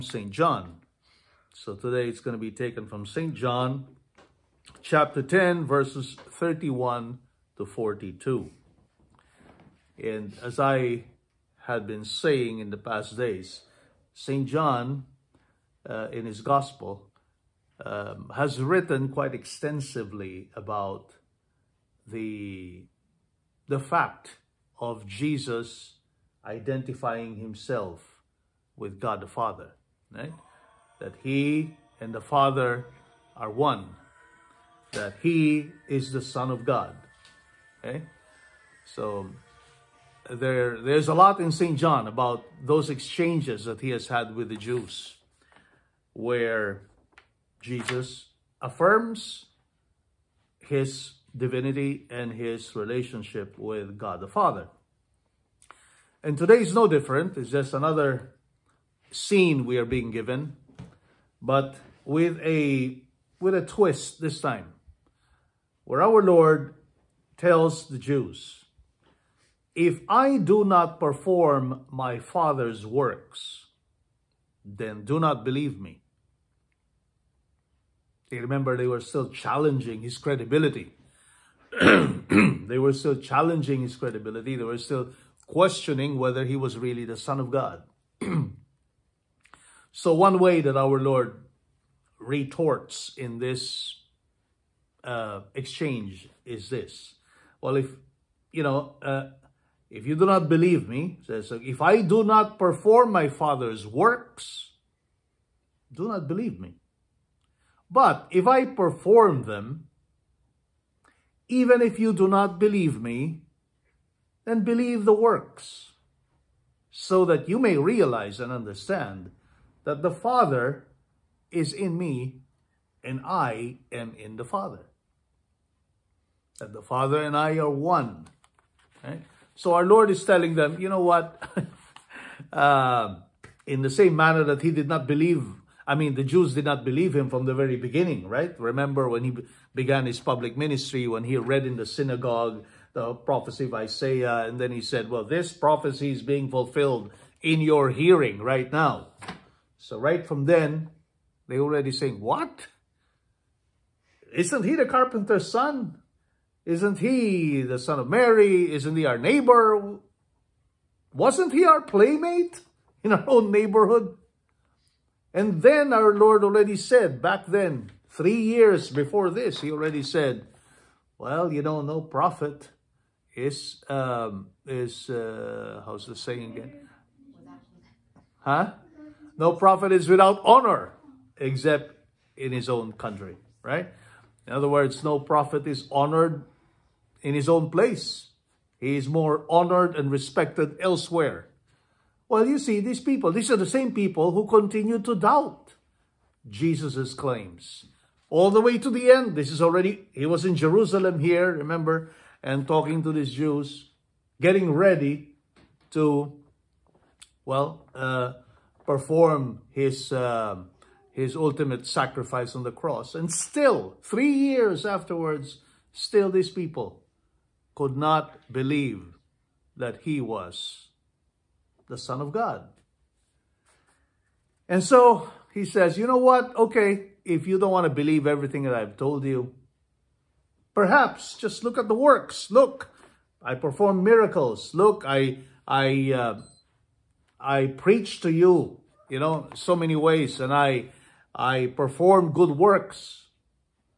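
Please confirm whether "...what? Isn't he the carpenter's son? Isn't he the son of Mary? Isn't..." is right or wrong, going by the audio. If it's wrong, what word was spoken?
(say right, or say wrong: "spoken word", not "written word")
right.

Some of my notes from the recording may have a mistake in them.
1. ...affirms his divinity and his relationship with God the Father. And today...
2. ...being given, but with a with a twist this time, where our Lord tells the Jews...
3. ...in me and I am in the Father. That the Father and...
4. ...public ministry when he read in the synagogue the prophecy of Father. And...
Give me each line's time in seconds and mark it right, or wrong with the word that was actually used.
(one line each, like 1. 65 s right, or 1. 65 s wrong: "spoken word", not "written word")
1. 48 s right
2. 59 s right
3. 121 s right
4. 140 s wrong: "Isaiah", not "Father".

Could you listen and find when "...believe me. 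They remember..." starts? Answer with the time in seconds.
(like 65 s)
75 s.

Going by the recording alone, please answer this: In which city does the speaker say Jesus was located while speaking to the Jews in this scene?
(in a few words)
Jerusalem.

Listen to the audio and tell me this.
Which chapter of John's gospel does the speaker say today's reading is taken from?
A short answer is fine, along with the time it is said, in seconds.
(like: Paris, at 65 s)
10, at 4 s.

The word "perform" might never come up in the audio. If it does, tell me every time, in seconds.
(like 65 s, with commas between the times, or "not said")
70 s, 102 s, 108 s, 208 s, 233 s, 241 s.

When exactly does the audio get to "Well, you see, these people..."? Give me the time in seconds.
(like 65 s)
192 s.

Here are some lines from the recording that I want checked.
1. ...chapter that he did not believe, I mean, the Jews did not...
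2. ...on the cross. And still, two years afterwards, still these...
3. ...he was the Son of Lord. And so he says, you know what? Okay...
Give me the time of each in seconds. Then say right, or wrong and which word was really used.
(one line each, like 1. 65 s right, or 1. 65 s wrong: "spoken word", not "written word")
1. 134 s wrong: "manner", not "chapter"
2. 212 s wrong: "three", not "two"
3. 220 s wrong: "God", not "Lord".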